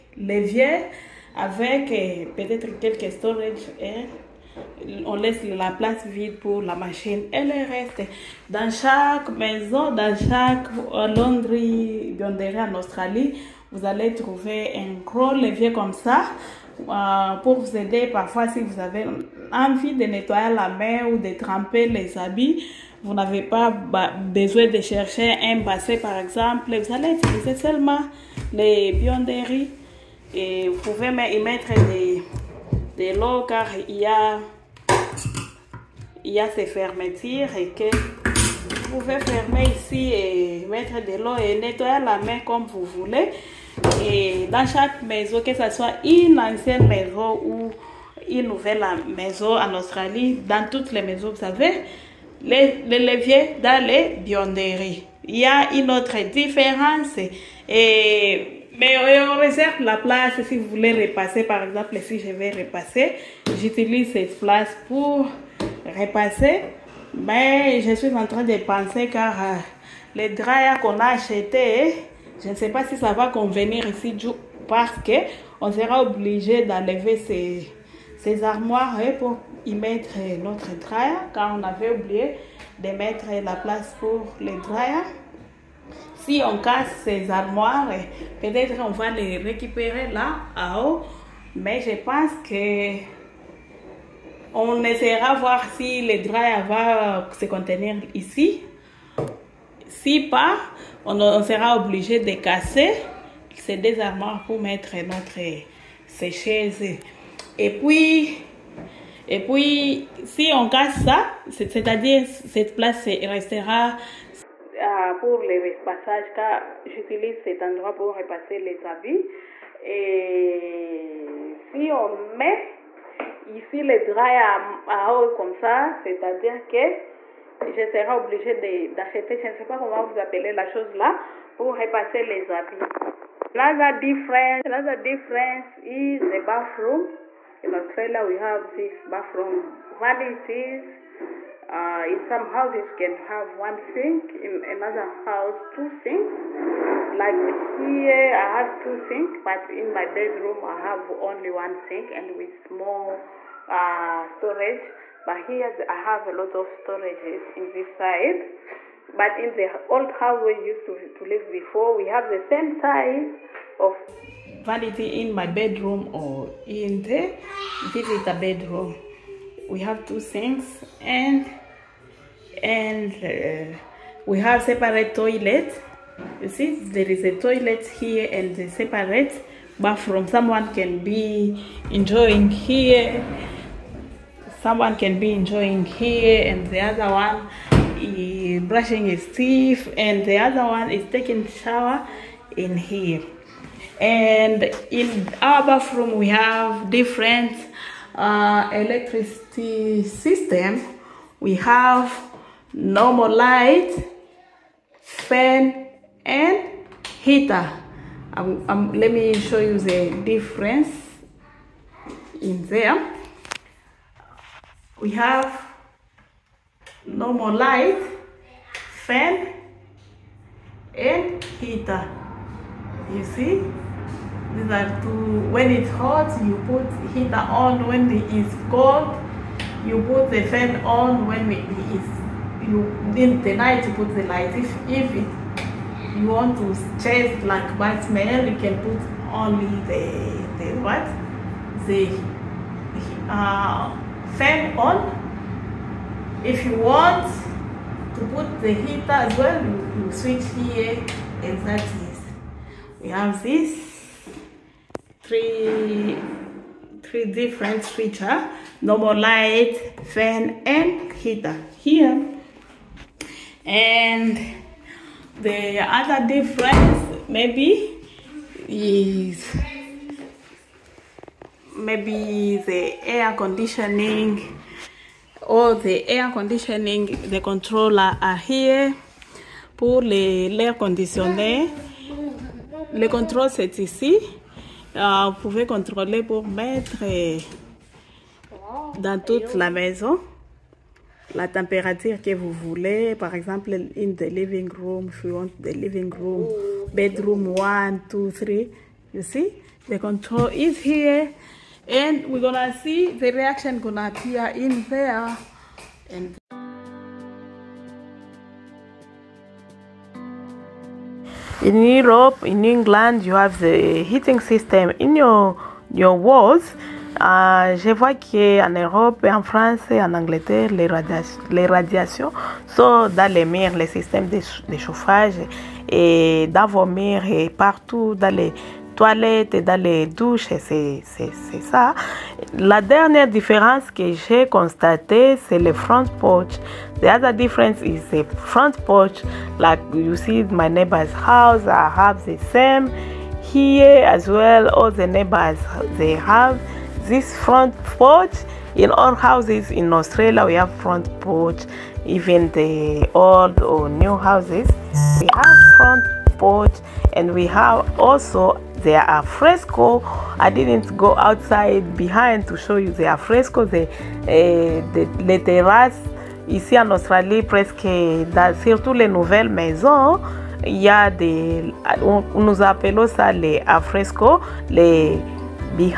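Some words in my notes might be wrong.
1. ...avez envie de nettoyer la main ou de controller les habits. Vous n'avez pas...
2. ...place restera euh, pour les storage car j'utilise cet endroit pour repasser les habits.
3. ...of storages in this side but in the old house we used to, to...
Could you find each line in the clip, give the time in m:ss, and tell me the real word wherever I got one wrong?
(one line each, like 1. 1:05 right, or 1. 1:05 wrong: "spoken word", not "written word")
1. 0:18 wrong: "tremper", not "controller"
2. 1:52 wrong: "repassage", not "storage"
3. 2:36 right.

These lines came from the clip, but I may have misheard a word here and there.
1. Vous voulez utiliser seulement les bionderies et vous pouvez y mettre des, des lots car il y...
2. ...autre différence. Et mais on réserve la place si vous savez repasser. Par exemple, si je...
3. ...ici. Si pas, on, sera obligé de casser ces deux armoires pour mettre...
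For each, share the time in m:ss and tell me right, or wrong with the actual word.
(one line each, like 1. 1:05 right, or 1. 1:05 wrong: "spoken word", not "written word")
1. 0:26 wrong: "allez", not "voulez"
2. 0:55 wrong: "voulez", not "savez"
3. 1:38 right.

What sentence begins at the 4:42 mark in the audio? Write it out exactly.
le contrôle c'est ici Ah, vous pouvez contrôler pour mettre dans toute la maison la température que vous voulez.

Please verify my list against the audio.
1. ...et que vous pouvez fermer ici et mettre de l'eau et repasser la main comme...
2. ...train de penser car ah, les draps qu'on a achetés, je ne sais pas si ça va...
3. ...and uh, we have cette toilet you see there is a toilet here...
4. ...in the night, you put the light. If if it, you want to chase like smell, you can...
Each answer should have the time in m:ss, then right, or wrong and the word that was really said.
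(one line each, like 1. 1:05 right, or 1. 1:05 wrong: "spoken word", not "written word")
1. 0:37 wrong: "nettoyer", not "repasser"
2. 1:08 right
3. 2:52 wrong: "separate", not "cette"
4. 3:53 right.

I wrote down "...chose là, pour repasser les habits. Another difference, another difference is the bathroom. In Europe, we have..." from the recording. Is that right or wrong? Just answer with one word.
wrong.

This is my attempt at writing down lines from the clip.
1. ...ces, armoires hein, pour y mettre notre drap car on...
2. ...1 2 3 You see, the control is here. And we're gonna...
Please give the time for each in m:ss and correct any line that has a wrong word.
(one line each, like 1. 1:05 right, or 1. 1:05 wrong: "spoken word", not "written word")
1. 1:18 right
2. 4:57 right.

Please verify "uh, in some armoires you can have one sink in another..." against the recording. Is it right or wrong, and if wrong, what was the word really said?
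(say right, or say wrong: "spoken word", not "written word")
wrong: "houses", not "armoires".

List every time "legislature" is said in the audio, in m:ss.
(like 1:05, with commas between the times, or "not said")
not said.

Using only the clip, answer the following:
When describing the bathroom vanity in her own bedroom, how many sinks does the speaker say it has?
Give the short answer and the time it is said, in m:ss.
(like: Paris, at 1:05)
1, at 2:31.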